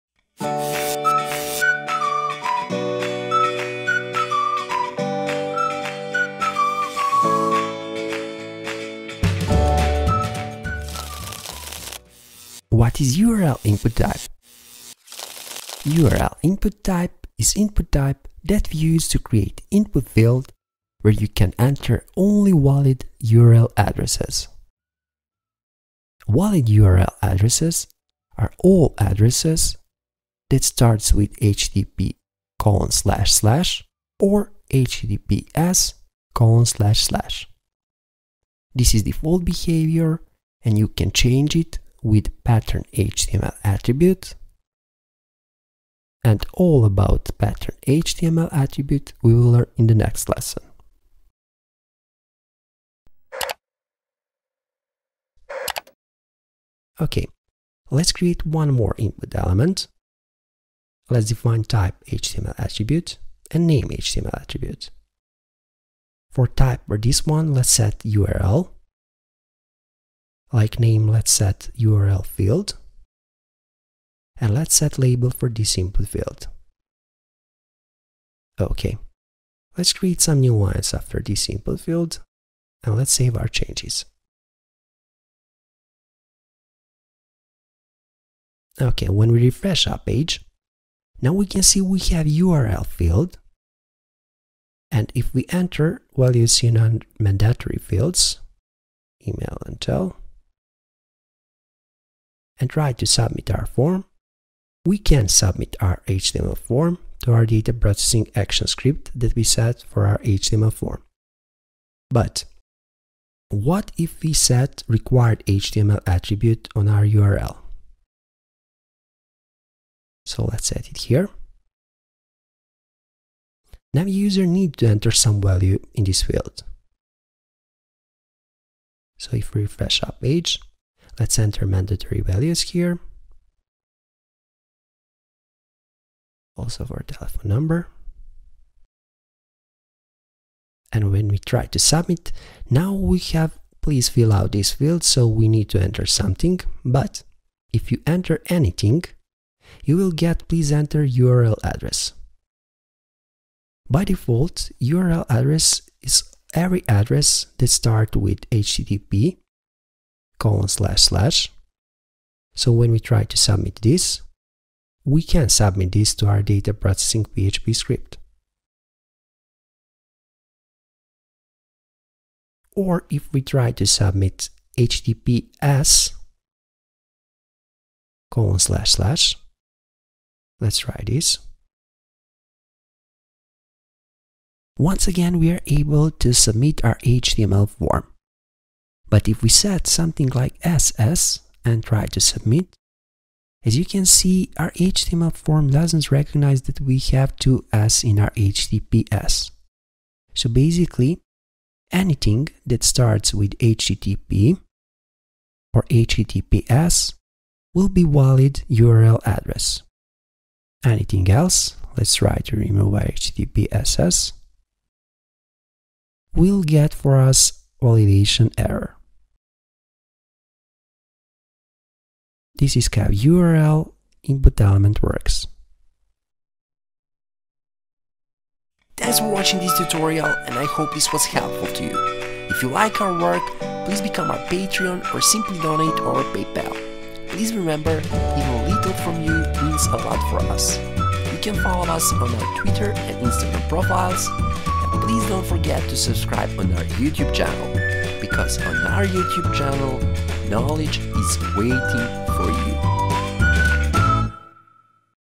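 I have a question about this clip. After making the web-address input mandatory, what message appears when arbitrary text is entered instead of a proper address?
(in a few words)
please enter URL address.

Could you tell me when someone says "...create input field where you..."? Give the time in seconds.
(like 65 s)
19 s.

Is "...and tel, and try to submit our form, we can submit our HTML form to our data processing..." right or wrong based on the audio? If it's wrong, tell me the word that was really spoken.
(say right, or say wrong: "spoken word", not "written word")
right.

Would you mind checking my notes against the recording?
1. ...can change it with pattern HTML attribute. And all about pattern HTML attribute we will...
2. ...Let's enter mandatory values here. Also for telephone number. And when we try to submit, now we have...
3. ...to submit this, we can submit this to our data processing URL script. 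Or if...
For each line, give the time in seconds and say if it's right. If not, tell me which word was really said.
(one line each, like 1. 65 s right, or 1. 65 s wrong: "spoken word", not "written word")
1. 40 s right
2. 131 s right
3. 163 s wrong: "PHP", not "URL".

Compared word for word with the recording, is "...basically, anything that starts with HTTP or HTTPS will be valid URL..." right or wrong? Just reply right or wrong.
right.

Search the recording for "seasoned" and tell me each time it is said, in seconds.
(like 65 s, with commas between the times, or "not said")
not said.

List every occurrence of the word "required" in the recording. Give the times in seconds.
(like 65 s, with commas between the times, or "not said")
114 s.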